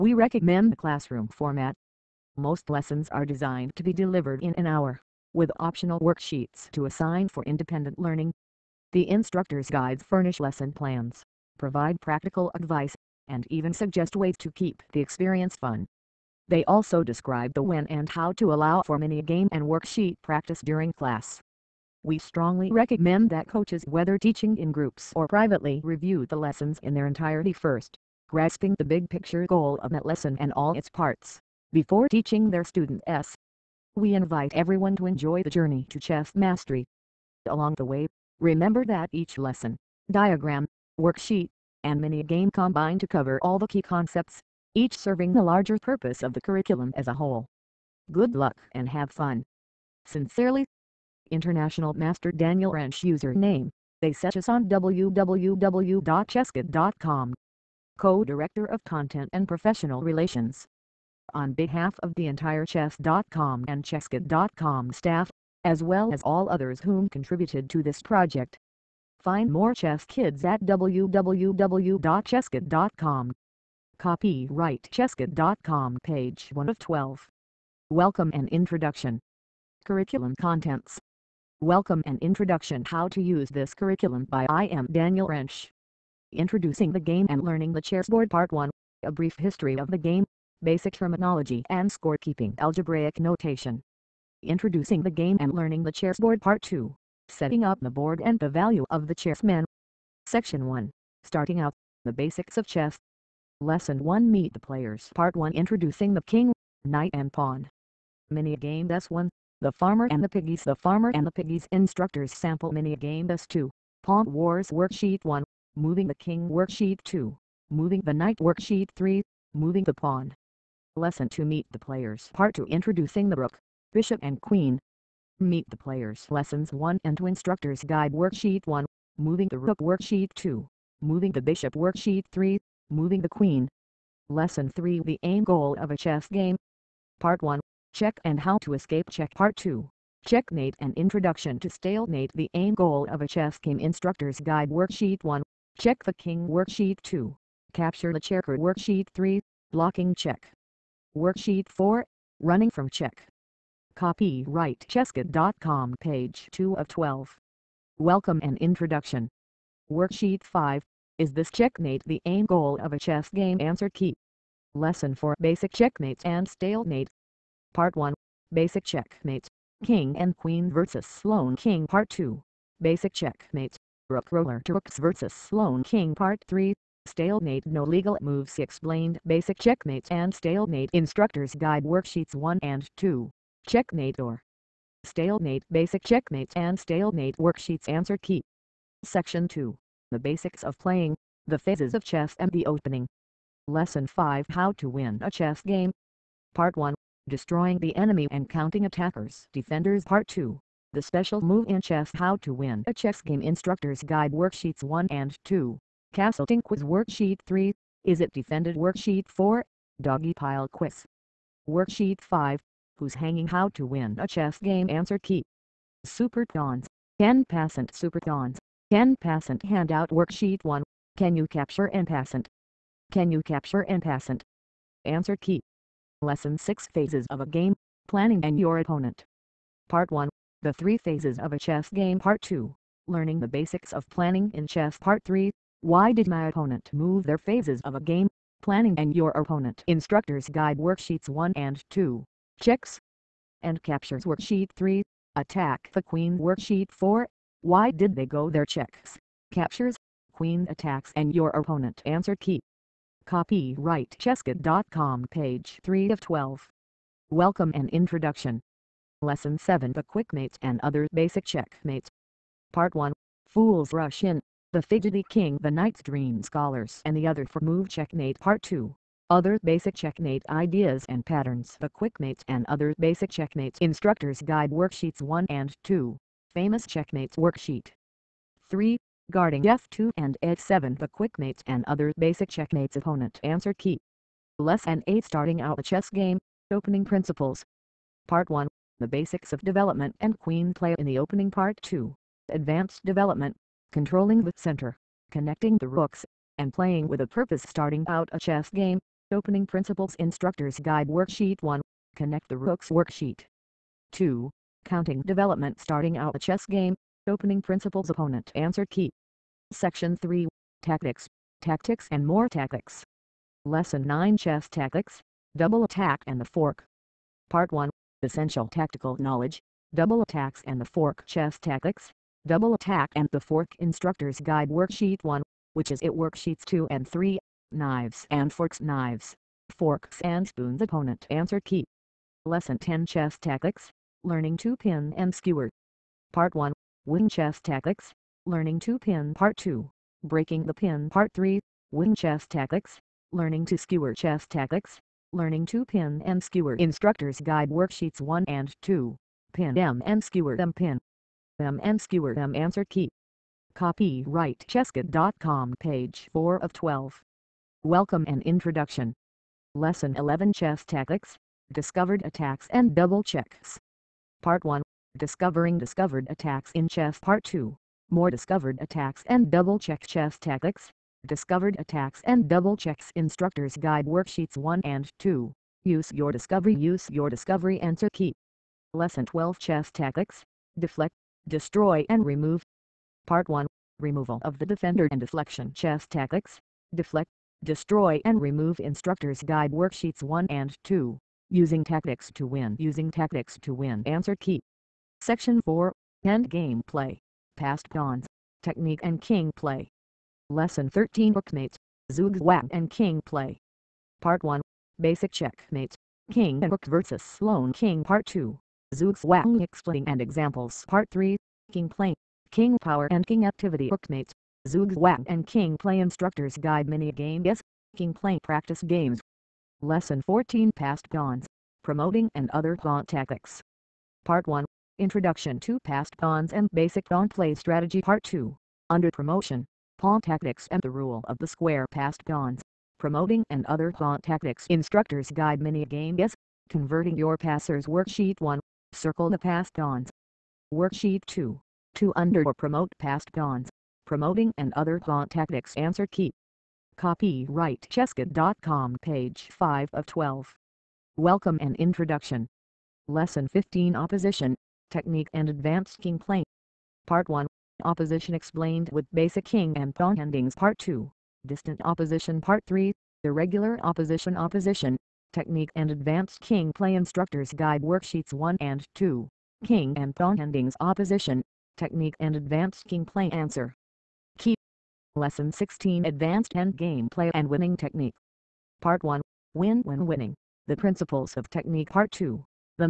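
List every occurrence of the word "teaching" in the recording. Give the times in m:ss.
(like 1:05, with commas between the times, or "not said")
0:24, 0:32.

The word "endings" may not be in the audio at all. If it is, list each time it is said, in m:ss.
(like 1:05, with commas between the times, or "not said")
7:40, 7:50.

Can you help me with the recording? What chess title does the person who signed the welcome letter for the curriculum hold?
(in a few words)
International Master.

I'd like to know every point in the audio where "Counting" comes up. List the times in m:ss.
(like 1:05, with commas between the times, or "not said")
3:18, 5:04.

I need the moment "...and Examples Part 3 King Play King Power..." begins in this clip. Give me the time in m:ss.
6:50.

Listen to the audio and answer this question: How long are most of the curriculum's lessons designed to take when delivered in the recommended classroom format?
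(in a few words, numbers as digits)
an hour.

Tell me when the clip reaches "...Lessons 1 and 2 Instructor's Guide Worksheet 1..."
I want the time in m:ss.
2:06.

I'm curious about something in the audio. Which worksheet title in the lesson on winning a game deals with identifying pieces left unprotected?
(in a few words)
Who's Hanging.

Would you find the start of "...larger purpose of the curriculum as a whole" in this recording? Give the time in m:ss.
0:45.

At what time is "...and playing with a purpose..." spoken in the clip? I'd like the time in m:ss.
4:56.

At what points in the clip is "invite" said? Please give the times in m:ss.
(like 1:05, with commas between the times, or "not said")
0:34.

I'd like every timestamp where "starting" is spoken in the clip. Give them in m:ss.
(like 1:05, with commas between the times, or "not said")
1:41, 4:45, 4:57, 5:05.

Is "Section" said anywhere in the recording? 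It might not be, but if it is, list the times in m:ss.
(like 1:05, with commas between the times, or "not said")
1:40, 3:09, 5:09, 6:35.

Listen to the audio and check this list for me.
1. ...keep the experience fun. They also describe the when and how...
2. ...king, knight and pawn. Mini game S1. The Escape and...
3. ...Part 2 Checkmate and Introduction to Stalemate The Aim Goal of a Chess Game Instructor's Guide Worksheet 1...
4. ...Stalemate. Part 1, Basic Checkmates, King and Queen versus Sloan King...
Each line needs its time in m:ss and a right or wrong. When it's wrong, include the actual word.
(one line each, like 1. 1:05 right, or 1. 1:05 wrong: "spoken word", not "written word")
1. 0:14 right
2. 1:46 wrong: "Farmer", not "Escape"
3. 2:19 right
4. 2:46 right.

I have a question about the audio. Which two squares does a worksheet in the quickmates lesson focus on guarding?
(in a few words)
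F2 and F7.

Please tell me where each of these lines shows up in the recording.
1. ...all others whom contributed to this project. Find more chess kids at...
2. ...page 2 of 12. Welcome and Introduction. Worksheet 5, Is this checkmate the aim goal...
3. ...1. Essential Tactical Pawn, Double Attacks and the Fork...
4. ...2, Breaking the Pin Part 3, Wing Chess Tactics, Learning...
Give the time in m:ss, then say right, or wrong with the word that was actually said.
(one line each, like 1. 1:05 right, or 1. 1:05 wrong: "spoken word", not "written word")
1. 1:06 right
2. 2:35 right
3. 5:17 wrong: "Knowledge", not "Pawn"
4. 5:39 right.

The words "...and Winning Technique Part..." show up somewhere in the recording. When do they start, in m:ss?
7:57.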